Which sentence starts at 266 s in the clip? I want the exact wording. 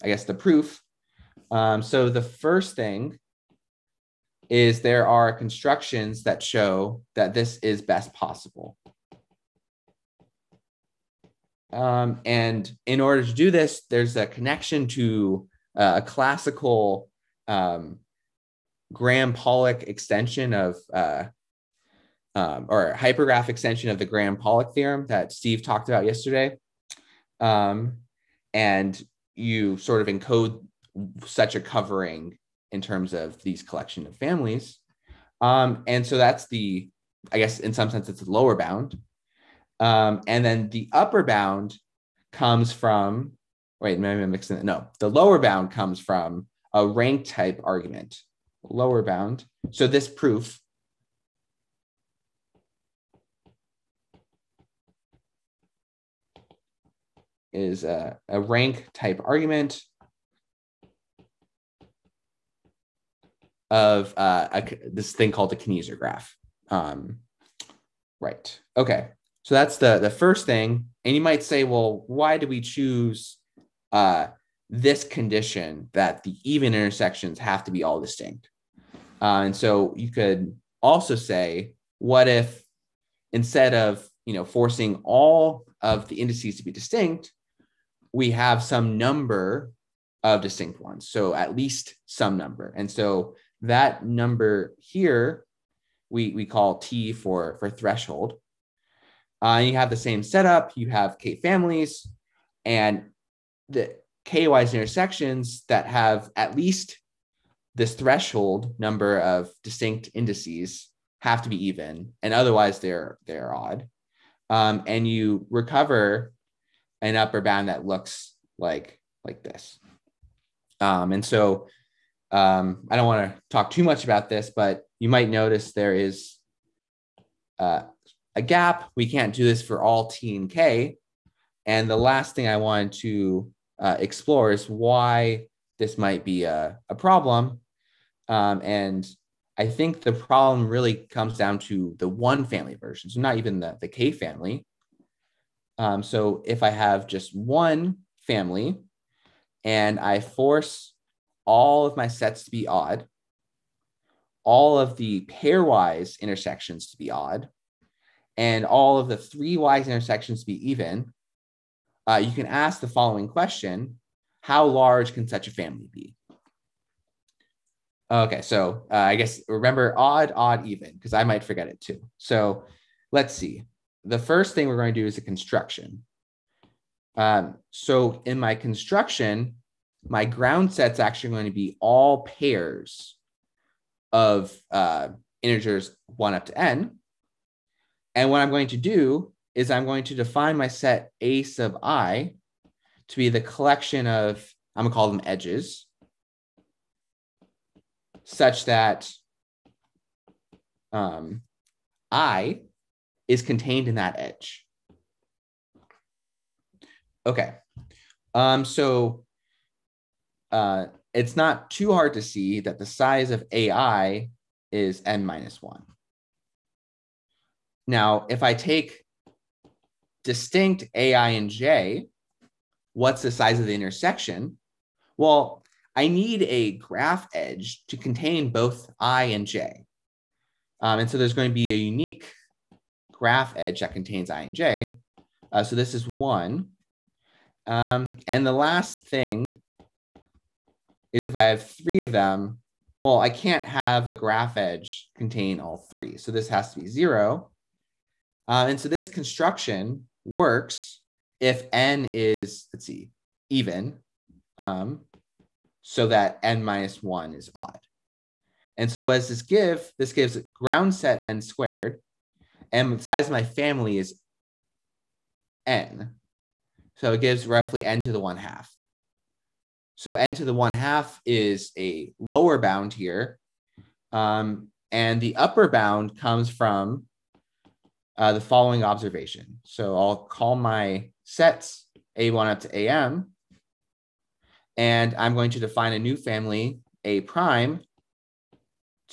So it gives roughly n to the one half.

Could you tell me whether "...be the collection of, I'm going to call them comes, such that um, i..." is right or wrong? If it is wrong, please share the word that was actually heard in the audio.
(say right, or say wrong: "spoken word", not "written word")
wrong: "edges", not "comes".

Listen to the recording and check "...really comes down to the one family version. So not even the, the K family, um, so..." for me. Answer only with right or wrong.
right.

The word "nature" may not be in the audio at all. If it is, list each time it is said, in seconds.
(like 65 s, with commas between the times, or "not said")
not said.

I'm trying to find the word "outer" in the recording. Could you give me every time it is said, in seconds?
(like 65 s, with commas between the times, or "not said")
not said.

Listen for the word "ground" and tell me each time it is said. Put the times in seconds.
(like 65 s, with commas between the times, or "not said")
180 s, 260 s.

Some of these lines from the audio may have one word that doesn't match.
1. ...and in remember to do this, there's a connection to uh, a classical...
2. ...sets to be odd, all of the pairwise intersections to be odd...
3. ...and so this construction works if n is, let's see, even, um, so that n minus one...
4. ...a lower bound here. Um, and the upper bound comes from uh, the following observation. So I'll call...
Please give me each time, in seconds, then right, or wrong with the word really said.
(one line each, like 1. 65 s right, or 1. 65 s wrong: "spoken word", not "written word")
1. 12 s wrong: "order", not "remember"
2. 152 s right
3. 248 s right
4. 271 s right.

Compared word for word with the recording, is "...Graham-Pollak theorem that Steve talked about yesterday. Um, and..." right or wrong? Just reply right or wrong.
right.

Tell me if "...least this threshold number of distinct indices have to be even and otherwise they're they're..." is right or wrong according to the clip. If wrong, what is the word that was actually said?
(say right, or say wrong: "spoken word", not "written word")
right.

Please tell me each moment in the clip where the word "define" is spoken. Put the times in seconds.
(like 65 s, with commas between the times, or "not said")
190 s, 285 s.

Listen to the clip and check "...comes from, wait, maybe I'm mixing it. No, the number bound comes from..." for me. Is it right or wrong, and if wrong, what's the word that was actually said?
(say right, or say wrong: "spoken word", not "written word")
wrong: "lower", not "number".